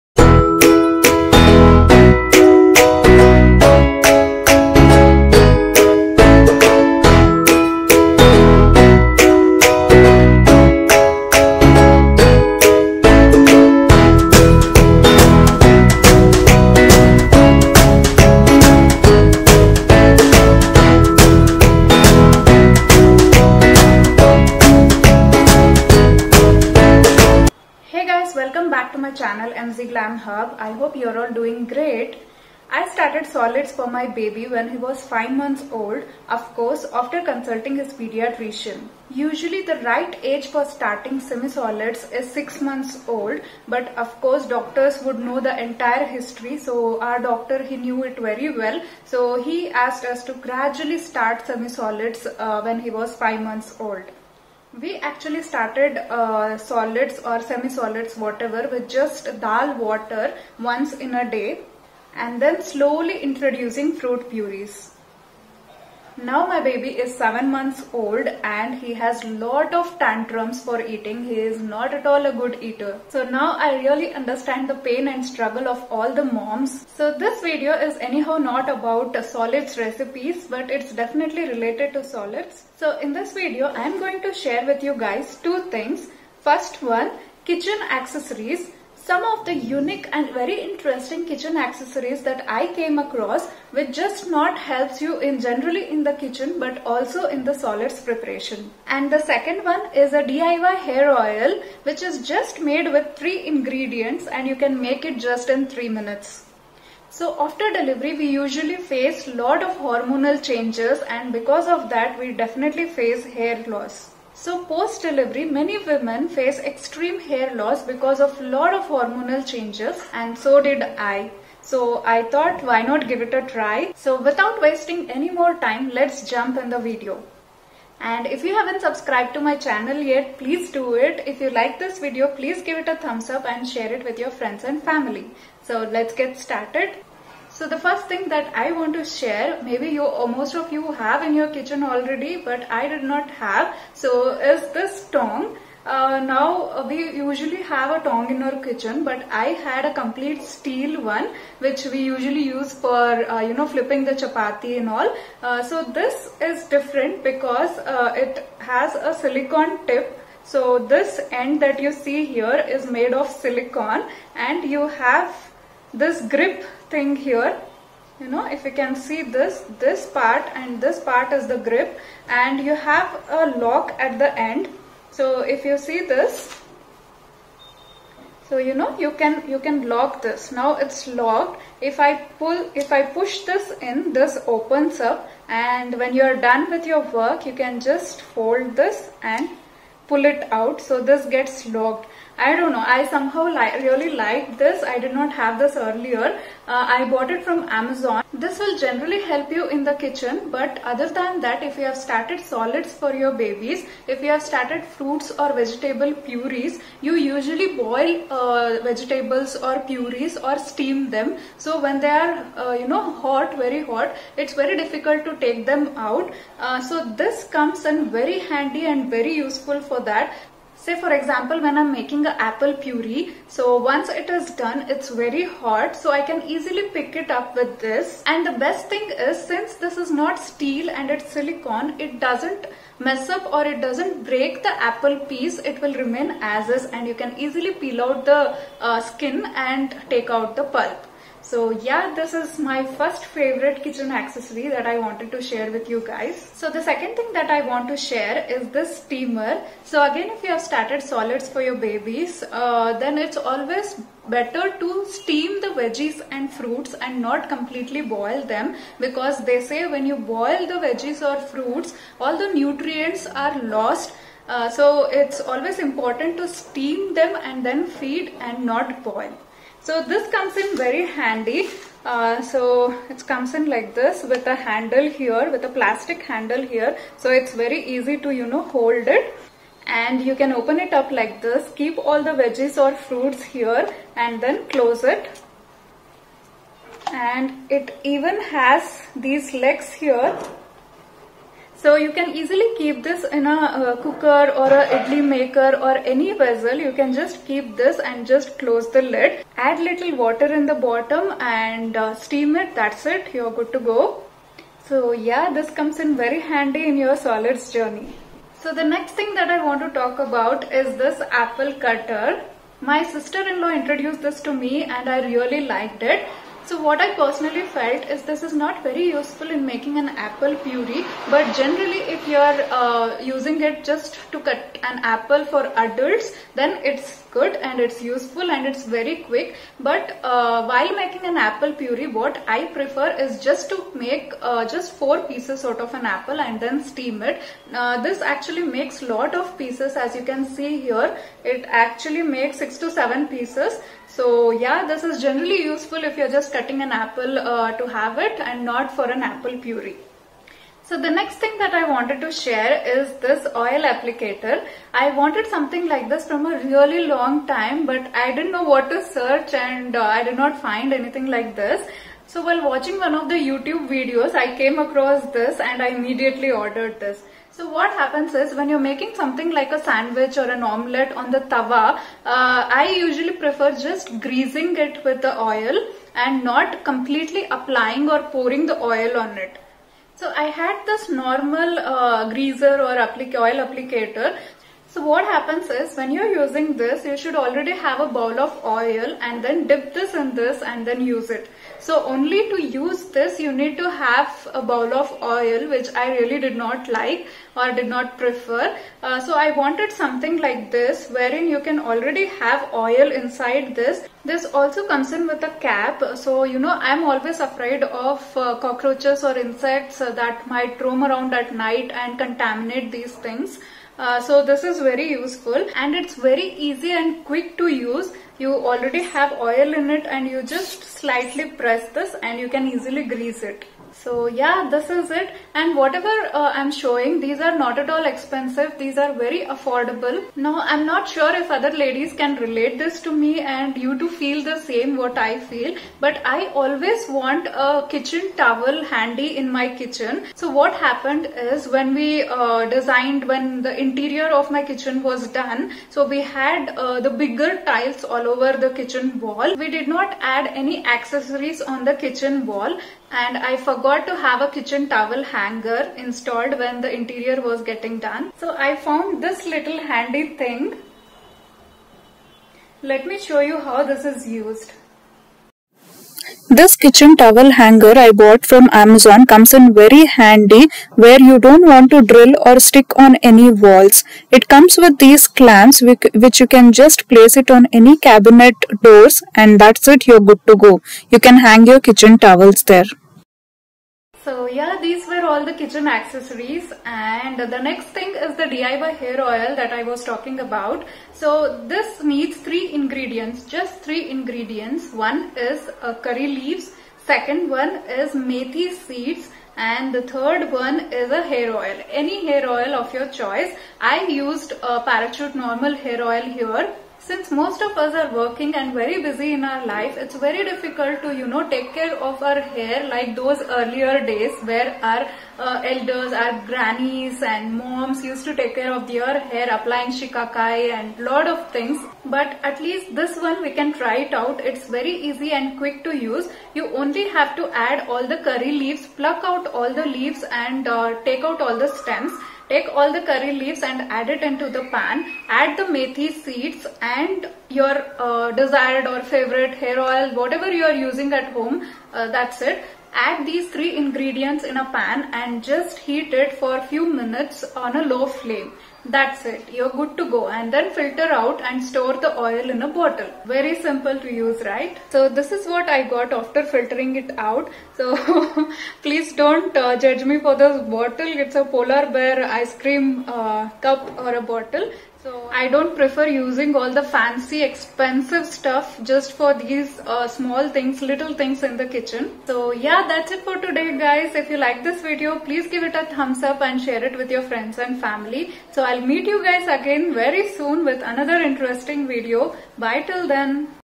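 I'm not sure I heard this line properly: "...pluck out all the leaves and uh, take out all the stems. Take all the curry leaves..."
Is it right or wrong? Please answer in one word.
right.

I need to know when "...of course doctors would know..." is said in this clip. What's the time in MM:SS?
00:44.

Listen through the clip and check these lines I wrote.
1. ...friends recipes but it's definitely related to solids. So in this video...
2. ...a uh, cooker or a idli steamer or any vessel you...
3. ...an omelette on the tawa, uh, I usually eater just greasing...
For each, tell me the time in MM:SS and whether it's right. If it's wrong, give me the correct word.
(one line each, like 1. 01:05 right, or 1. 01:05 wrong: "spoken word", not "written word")
1. 01:19 wrong: "solids", not "friends"
2. 04:53 wrong: "maker", not "steamer"
3. 06:10 wrong: "prefer", not "eater".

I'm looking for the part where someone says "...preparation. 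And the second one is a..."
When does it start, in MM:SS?
01:38.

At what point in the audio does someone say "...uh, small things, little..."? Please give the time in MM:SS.
09:29.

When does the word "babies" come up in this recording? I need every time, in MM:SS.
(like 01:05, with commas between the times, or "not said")
03:23, 04:11.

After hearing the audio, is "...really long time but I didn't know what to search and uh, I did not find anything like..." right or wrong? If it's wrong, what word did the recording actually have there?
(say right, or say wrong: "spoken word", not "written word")
right.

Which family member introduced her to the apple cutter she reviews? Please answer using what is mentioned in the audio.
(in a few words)
sister-in-law.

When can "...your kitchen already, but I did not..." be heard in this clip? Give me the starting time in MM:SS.
02:21.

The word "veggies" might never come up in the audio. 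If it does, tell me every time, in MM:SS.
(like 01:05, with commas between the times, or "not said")
04:15, 04:20, 04:42.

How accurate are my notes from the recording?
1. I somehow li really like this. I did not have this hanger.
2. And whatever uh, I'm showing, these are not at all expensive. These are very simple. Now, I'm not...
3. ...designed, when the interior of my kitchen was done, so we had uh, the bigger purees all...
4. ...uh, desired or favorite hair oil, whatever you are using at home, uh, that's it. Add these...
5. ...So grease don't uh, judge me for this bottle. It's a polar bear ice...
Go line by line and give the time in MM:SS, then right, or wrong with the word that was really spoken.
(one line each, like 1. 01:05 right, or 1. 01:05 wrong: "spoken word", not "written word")
1. 03:12 wrong: "earlier", not "hanger"
2. 07:05 wrong: "affordable", not "simple"
3. 07:22 wrong: "tiles", not "purees"
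4. 08:57 right
5. 09:17 wrong: "please", not "grease".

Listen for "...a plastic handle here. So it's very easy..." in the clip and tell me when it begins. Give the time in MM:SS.
04:35.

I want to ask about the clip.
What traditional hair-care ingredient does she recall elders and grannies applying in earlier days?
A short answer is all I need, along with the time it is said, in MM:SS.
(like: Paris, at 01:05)
shikakai, at 08:39.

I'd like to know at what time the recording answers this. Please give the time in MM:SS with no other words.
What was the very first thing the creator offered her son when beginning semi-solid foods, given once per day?
00:59.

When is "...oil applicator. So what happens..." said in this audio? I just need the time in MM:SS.
06:23.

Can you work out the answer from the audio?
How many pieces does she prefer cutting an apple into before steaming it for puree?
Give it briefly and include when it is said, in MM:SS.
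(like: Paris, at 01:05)
4, at 05:34.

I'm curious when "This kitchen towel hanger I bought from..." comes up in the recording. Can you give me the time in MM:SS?
07:46.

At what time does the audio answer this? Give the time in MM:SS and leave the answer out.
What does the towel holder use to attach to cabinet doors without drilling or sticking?
07:55.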